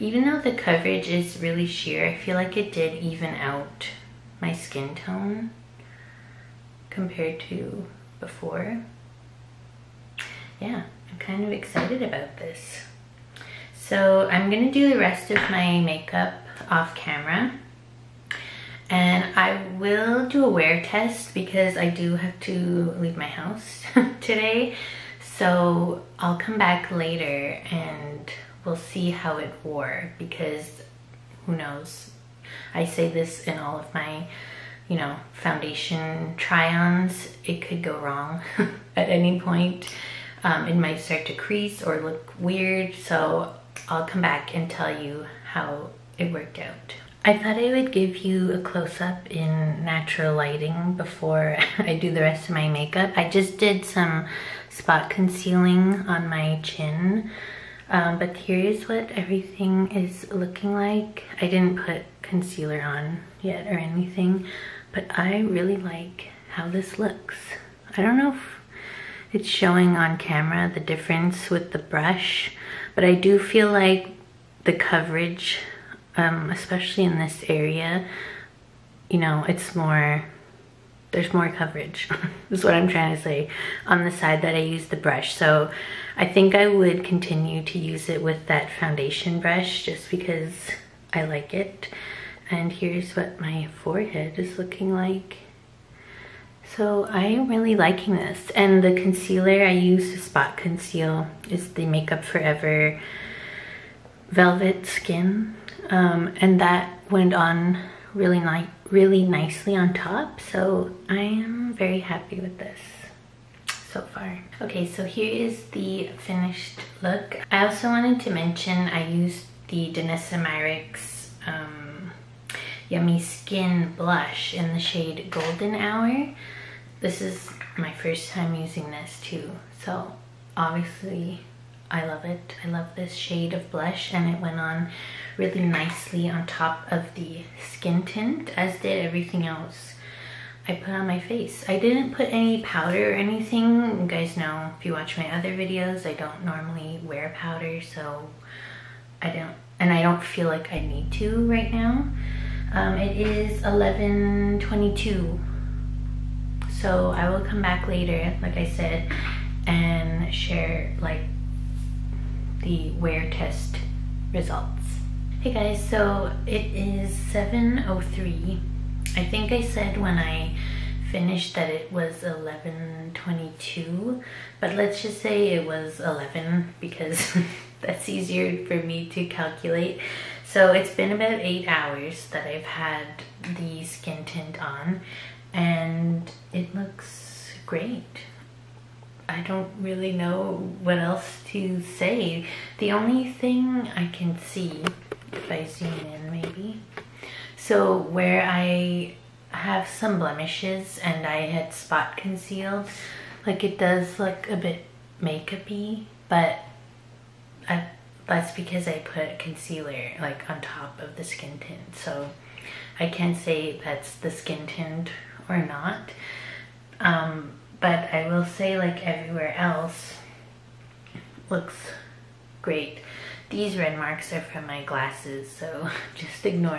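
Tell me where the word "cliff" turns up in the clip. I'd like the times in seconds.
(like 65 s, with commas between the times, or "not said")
not said.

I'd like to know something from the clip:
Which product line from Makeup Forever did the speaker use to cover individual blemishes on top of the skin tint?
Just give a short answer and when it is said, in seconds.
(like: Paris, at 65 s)
Velvet Skin, at 104 s.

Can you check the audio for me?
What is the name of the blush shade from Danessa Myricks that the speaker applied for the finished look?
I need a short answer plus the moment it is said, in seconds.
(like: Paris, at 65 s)
Golden Hour, at 125 s.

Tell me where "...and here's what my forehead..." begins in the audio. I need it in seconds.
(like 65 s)
92 s.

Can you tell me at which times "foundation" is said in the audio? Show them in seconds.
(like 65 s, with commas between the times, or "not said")
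35 s, 88 s.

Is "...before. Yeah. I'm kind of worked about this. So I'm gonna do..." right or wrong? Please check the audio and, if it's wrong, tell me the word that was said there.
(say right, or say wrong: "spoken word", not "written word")
wrong: "excited", not "worked".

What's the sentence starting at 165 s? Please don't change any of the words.
Hey guys, so it is 7.03.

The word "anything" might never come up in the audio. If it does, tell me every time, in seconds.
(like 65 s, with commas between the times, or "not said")
63 s, 143 s.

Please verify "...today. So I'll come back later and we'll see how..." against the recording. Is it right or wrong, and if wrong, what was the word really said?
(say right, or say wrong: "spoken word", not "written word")
right.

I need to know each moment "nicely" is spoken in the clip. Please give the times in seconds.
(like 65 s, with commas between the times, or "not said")
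109 s, 135 s.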